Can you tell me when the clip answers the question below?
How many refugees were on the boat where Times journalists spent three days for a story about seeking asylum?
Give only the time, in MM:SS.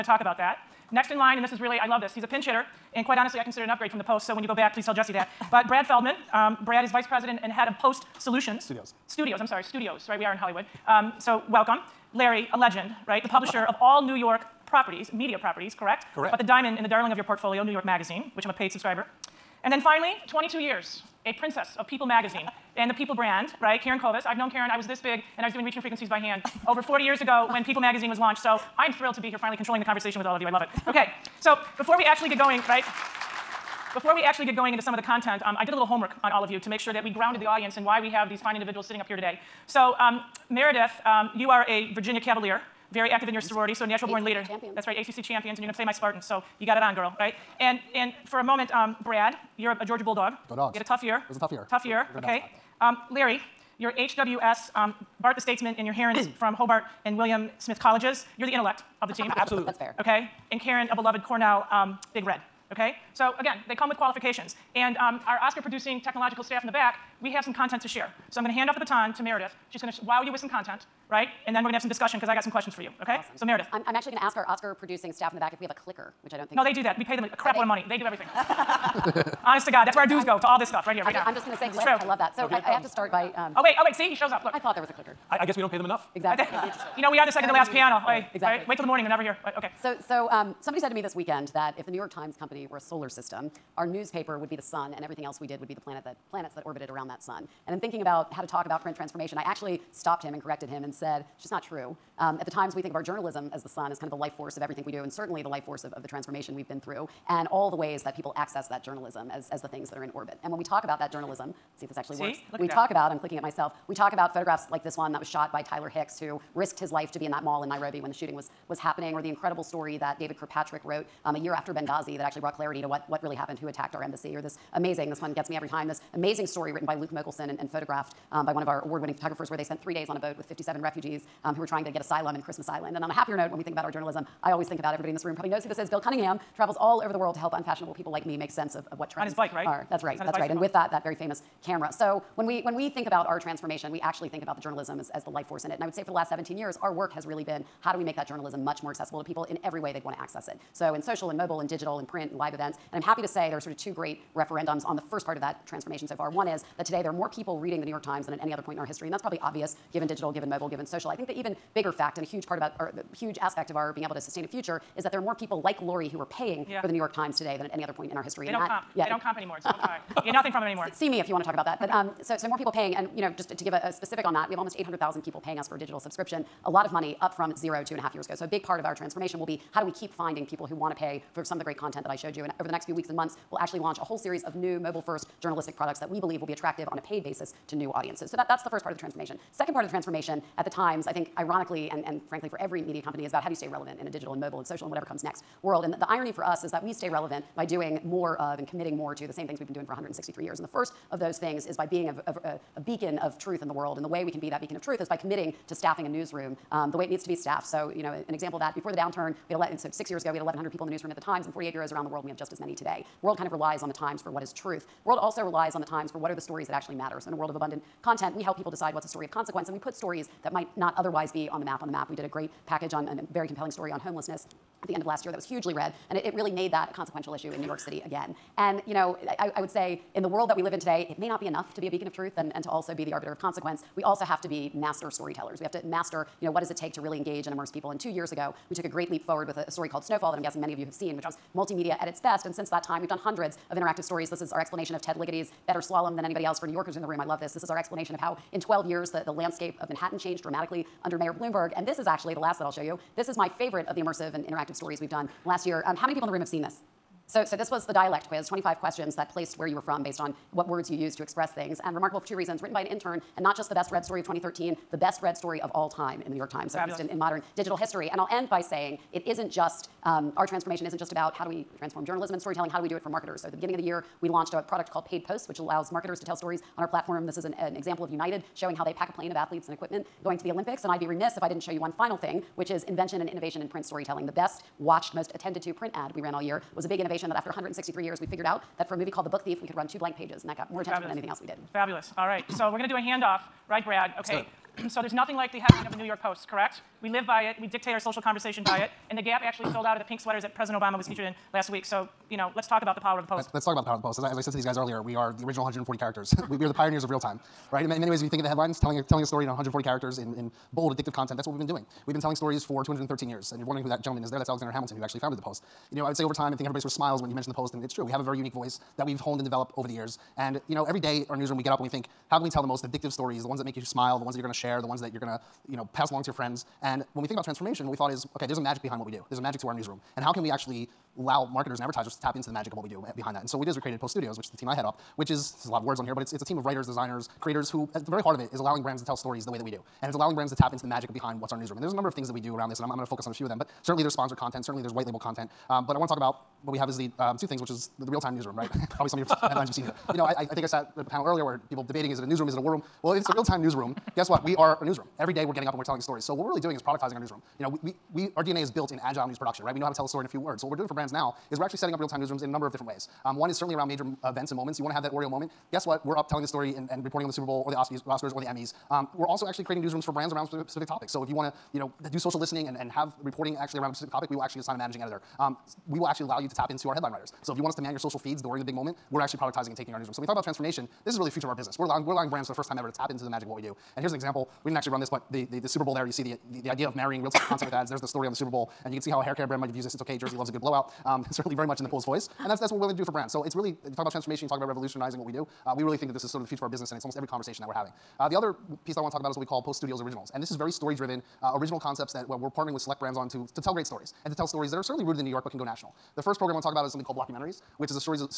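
02:10.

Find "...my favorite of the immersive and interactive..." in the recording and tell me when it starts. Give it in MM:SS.
04:13.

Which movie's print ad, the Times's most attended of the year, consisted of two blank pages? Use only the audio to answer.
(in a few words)
The Book Thief.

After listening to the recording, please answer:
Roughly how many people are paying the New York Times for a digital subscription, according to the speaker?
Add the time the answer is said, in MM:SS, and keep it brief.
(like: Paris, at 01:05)
800,000, at 02:54.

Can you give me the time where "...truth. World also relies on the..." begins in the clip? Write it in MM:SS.
03:34.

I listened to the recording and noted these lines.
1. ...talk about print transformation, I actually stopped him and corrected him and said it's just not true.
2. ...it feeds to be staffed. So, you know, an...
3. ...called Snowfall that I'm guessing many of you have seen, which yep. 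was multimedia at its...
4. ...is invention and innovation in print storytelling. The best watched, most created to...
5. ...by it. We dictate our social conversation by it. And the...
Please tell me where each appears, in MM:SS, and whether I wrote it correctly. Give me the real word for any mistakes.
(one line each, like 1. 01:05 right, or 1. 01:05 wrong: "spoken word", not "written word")
1. 01:38 right
2. 03:27 wrong: "needs", not "feeds"
3. 03:59 right
4. 04:42 wrong: "attended", not "created"
5. 04:57 right.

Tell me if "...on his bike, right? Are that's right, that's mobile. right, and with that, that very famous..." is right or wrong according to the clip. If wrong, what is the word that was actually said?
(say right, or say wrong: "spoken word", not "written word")
wrong: "bicycle", not "mobile".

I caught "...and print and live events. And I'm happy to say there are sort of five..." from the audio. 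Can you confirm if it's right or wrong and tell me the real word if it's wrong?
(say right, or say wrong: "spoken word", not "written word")
wrong: "two", not "five".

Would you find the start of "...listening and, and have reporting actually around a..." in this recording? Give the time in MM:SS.
06:12.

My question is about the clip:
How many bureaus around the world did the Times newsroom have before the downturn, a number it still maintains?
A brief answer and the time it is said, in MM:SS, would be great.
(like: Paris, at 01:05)
48, at 03:31.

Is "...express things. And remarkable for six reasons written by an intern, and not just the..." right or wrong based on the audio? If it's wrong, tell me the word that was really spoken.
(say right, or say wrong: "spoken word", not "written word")
wrong: "two", not "six".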